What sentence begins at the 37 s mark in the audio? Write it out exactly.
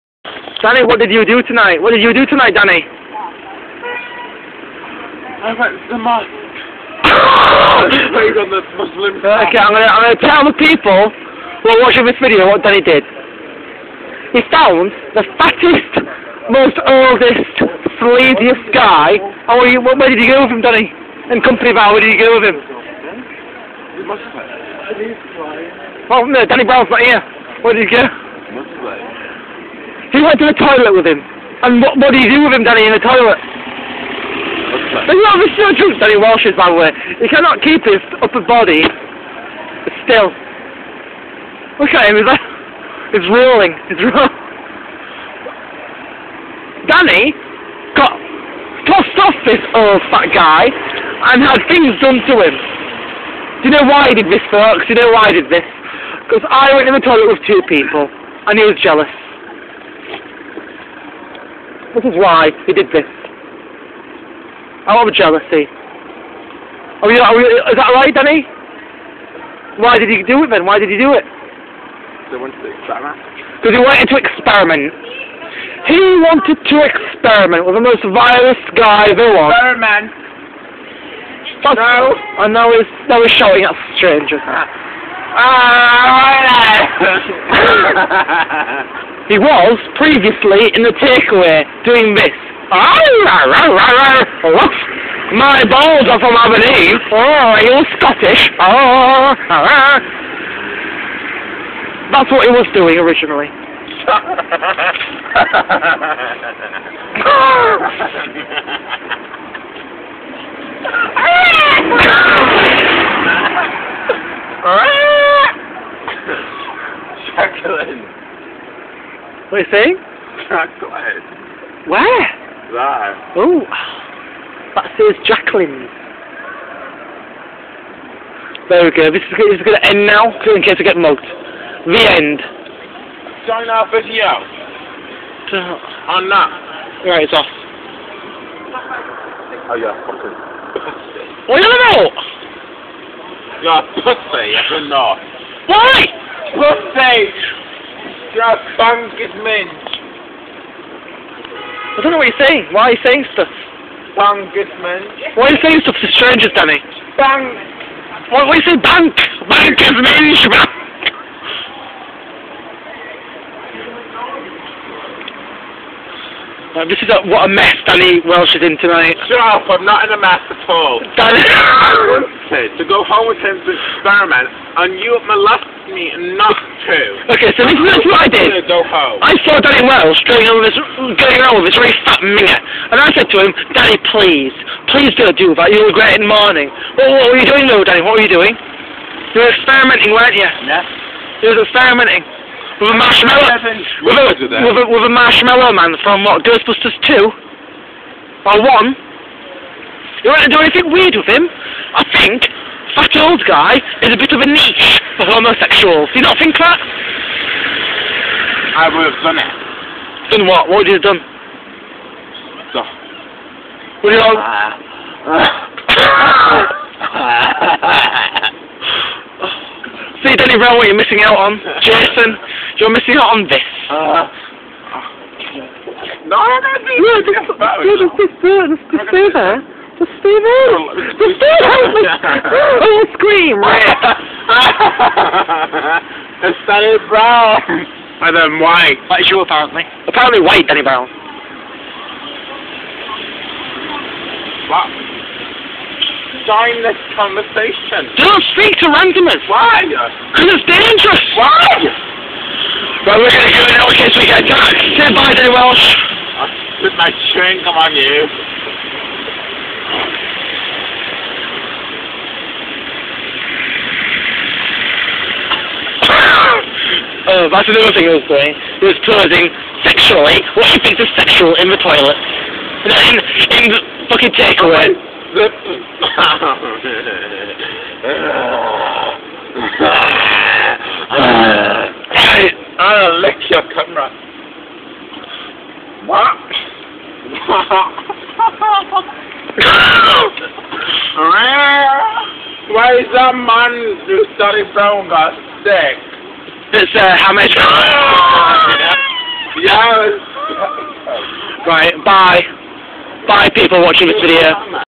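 He cannot keep his upper body still.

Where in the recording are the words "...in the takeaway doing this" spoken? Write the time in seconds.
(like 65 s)
90 s.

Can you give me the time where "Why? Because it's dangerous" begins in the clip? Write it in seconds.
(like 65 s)
249 s.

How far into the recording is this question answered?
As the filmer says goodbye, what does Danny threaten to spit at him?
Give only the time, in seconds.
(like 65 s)
257 s.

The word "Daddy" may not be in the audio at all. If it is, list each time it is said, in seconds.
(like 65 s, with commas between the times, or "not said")
179 s, 183 s, 187 s.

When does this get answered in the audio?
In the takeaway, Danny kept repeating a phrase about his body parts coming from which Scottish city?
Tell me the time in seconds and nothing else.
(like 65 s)
96 s.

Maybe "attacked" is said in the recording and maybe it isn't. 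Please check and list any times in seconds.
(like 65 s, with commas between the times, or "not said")
254 s.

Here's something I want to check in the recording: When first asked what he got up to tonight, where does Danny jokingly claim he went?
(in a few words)
The mosque.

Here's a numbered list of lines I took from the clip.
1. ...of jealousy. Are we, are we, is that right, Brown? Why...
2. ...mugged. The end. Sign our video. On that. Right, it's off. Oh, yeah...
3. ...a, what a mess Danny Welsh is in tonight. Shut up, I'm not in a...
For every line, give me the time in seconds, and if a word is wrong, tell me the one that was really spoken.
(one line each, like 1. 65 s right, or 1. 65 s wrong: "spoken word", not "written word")
1. 65 s wrong: "Danny", not "Brown"
2. 130 s right
3. 167 s right.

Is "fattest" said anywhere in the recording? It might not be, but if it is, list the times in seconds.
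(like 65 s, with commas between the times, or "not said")
15 s.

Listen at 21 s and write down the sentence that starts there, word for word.
In company bar, where did you go with him?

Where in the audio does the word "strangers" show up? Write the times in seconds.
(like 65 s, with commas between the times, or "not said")
83 s, 156 s.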